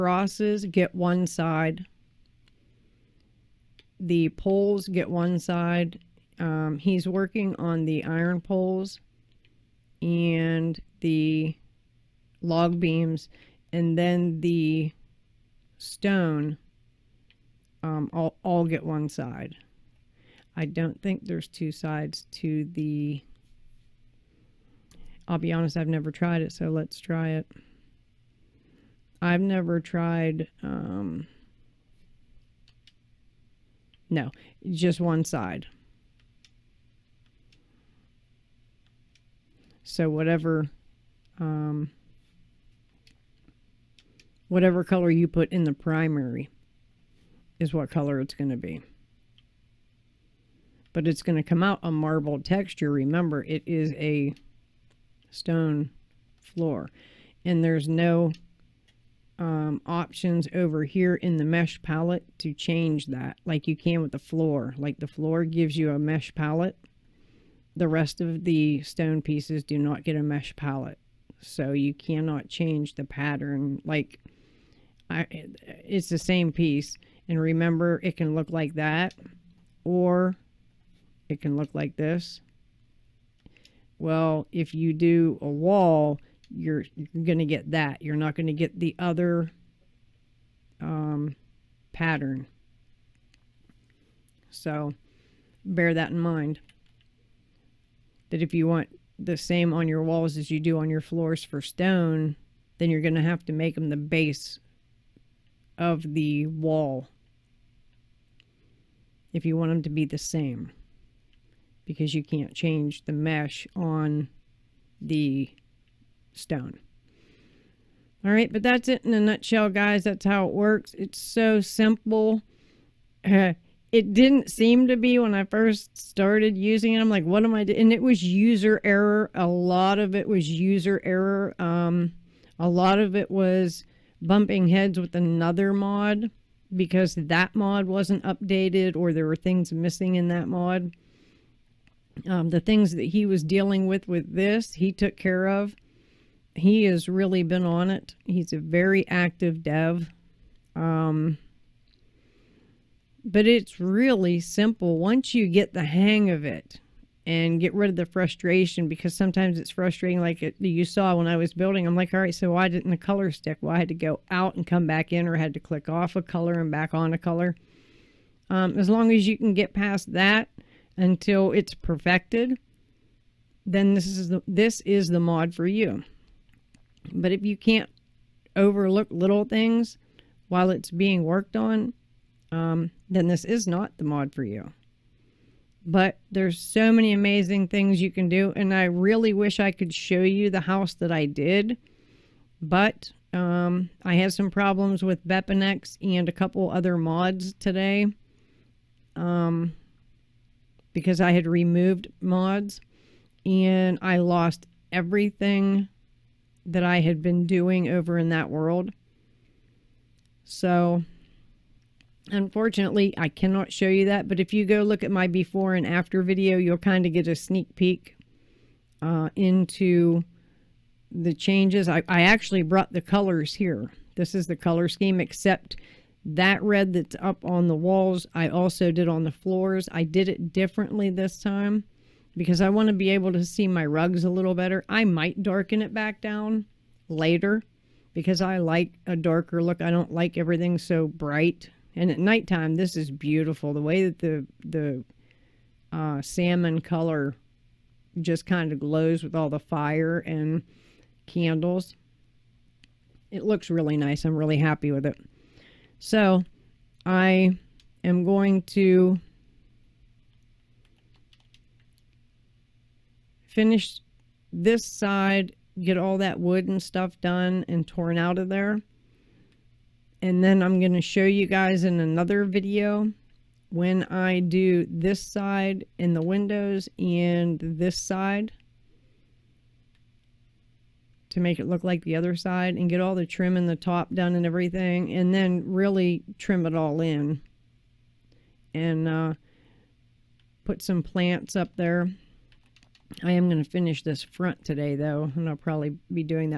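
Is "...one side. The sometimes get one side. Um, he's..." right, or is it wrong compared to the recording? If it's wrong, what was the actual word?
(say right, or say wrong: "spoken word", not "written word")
wrong: "poles", not "sometimes".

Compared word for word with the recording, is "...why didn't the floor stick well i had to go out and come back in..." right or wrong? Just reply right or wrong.
wrong.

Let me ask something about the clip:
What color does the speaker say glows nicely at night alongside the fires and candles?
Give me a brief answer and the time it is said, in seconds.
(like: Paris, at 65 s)
Salmon, at 246 s.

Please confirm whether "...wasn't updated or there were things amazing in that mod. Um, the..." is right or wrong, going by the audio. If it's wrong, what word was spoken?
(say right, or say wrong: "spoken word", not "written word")
wrong: "missing", not "amazing".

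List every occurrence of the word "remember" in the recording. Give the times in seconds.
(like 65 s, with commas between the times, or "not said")
52 s, 77 s.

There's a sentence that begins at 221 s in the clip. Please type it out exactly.
I, I actually brought the colors here.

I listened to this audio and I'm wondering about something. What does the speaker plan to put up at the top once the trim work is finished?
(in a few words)
Plants.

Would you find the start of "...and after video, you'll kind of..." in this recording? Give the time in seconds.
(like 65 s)
215 s.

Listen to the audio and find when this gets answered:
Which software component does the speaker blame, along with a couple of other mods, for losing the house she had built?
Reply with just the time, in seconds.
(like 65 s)
195 s.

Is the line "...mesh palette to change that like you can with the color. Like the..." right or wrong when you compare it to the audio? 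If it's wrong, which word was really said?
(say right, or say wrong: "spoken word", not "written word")
wrong: "floor", not "color".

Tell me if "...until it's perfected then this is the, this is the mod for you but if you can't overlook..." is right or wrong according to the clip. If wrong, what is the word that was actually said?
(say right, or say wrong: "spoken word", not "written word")
right.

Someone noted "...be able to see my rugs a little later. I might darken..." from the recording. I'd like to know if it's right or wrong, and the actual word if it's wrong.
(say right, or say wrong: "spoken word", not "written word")
wrong: "better", not "later".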